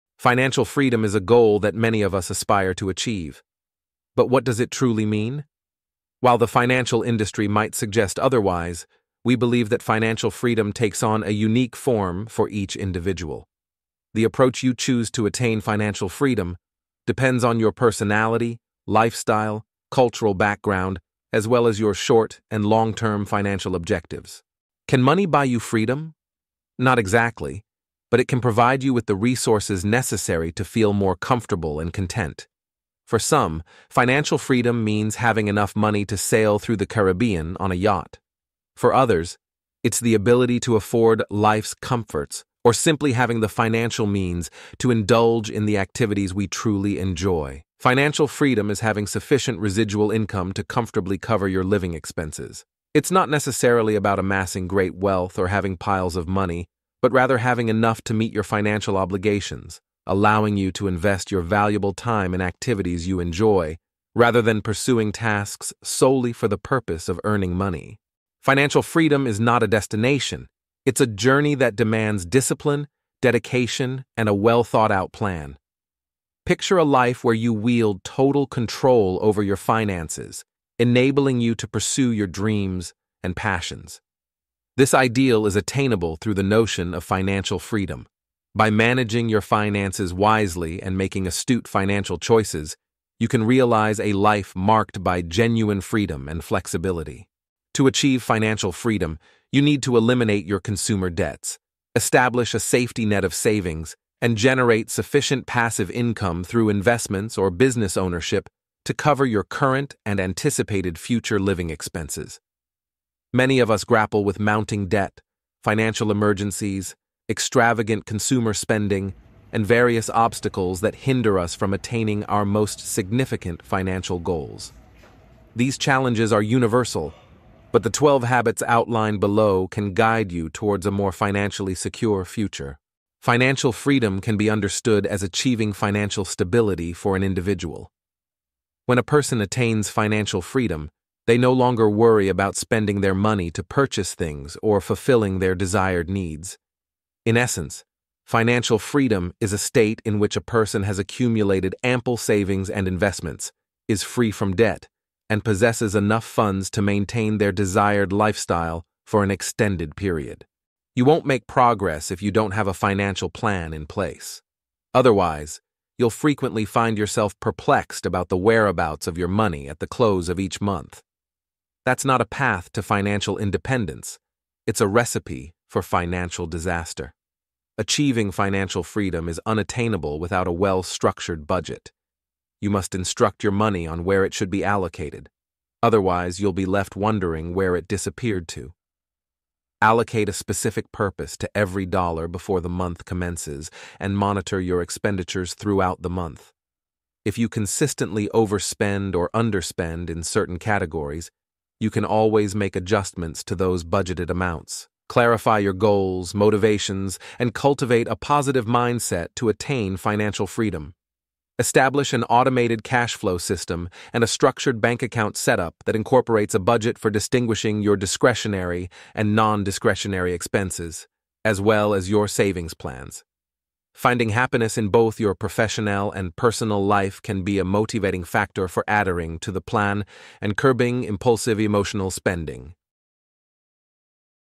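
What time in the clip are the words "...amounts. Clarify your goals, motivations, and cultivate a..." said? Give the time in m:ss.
3:24.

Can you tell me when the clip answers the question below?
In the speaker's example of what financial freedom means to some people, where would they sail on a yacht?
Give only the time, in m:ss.
0:36.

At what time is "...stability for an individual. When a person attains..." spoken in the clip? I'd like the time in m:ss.
2:16.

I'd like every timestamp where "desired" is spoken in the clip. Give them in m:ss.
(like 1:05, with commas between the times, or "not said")
2:25, 2:37.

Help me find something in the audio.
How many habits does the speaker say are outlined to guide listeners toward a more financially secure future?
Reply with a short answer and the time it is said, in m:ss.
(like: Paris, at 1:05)
12, at 2:07.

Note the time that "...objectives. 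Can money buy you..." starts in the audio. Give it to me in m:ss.
0:23.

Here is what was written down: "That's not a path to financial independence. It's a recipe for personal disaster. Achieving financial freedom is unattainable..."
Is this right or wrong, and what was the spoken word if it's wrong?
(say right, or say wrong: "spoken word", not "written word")
wrong: "financial", not "personal".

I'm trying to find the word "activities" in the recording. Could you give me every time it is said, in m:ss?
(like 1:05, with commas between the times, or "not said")
0:45, 1:02.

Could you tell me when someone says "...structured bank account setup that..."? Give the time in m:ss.
3:34.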